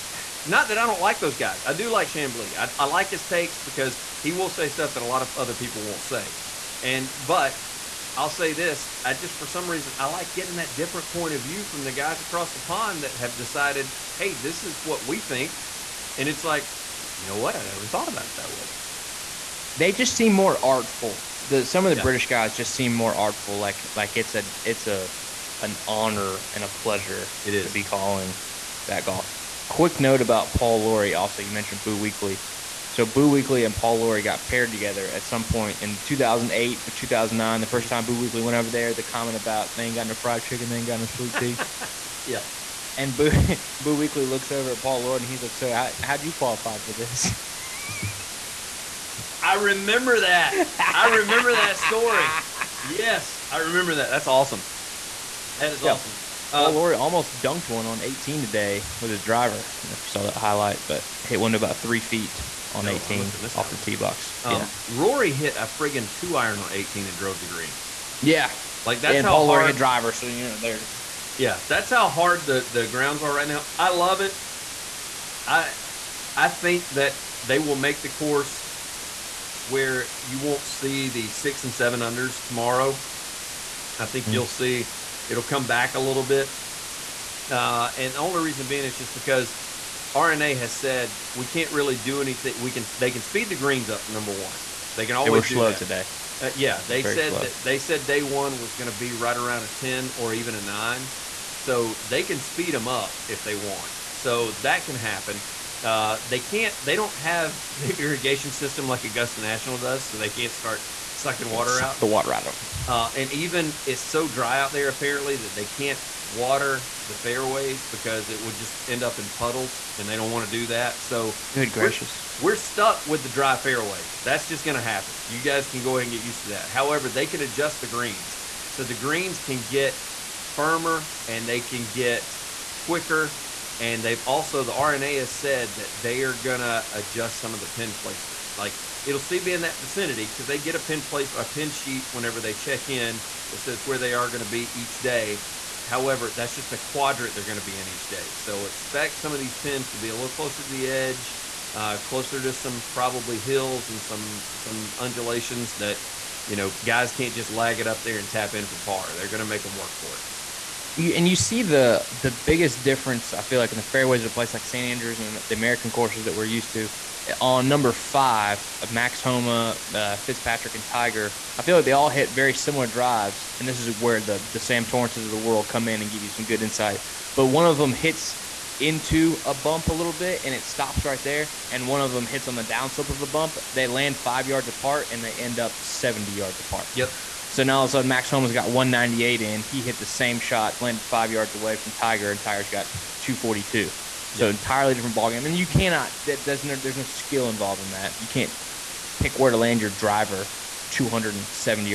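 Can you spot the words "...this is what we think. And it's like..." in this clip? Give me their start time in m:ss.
0:14.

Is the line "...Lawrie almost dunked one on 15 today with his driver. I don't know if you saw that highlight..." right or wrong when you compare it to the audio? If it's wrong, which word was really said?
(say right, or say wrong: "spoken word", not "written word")
wrong: "18", not "15".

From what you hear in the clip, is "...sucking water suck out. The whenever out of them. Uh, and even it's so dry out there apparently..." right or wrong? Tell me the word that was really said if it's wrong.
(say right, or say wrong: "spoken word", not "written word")
wrong: "water", not "whenever".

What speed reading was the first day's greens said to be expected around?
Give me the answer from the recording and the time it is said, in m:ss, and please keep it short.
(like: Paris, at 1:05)
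10, at 1:39.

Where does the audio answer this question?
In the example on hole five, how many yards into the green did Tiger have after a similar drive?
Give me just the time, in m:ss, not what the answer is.
3:13.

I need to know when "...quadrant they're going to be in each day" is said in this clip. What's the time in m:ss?
2:26.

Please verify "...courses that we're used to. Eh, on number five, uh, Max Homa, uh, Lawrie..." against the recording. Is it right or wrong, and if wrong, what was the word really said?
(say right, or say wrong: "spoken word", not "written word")
wrong: "Fitzpatrick", not "Lawrie".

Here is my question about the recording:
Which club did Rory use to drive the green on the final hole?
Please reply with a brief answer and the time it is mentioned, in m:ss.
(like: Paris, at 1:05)
Two iron, at 1:06.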